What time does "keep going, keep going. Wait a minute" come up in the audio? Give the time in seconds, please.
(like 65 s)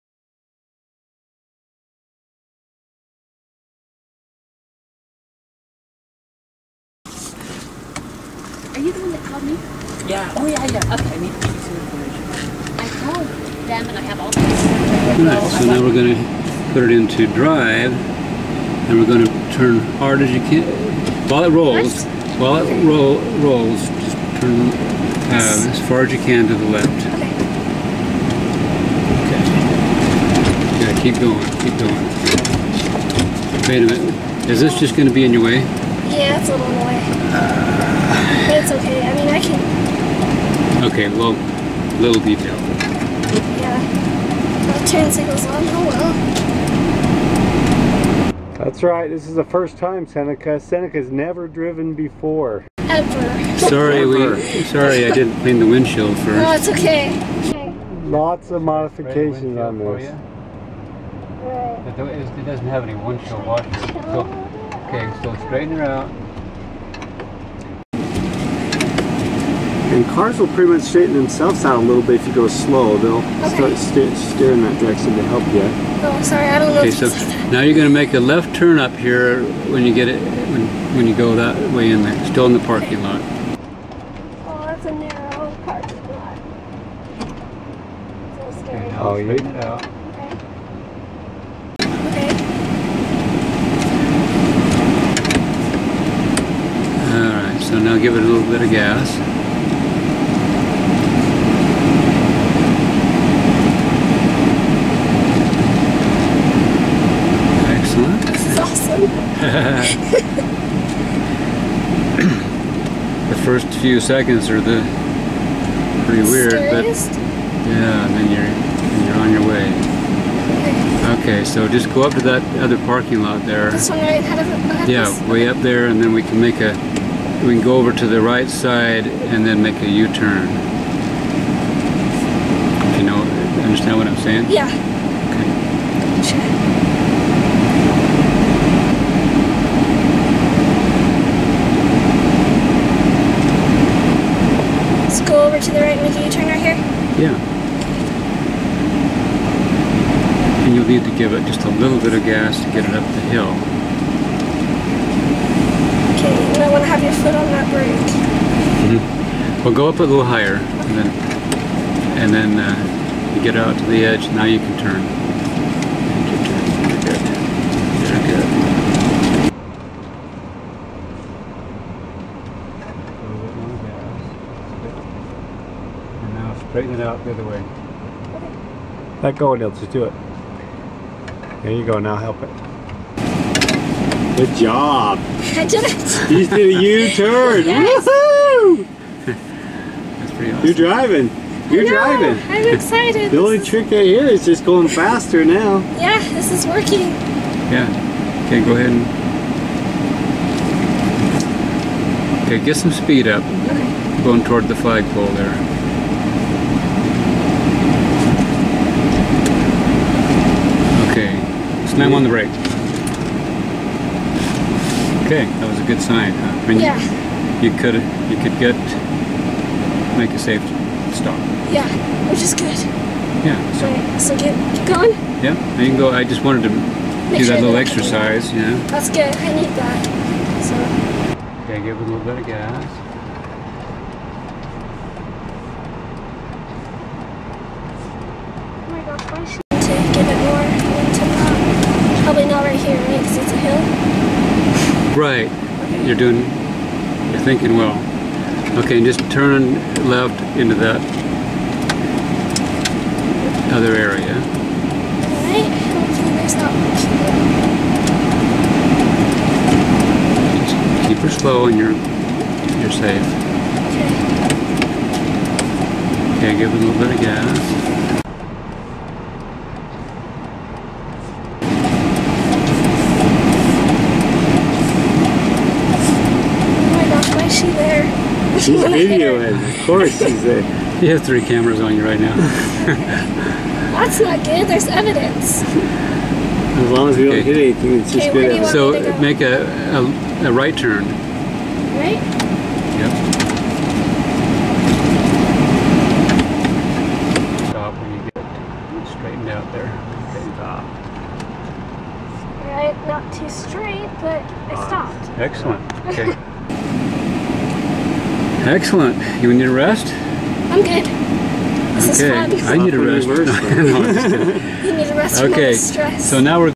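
31 s.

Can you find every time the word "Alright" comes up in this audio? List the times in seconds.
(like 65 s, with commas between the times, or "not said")
15 s, 255 s.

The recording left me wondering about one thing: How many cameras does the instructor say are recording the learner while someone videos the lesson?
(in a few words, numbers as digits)
3.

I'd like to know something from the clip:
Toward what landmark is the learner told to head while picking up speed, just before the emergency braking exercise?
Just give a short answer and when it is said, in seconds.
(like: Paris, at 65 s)
the flagpole, at 204 s.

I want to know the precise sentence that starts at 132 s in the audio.
You know, understand what I'm saying?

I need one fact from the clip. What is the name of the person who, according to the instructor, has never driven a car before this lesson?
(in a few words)
Seneca.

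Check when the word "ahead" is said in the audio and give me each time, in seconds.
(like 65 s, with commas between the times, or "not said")
124 s, 198 s.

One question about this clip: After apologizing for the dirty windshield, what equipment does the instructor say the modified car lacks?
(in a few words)
windshield washers.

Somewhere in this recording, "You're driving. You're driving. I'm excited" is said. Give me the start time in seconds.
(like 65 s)
190 s.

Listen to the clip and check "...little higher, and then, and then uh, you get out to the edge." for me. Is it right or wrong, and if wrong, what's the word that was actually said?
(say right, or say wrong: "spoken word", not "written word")
right.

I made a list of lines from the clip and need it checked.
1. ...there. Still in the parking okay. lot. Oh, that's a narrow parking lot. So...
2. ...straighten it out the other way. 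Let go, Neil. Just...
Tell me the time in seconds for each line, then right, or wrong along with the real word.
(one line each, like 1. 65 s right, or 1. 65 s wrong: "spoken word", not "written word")
1. 82 s right
2. 176 s right.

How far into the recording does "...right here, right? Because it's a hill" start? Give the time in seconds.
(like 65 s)
242 s.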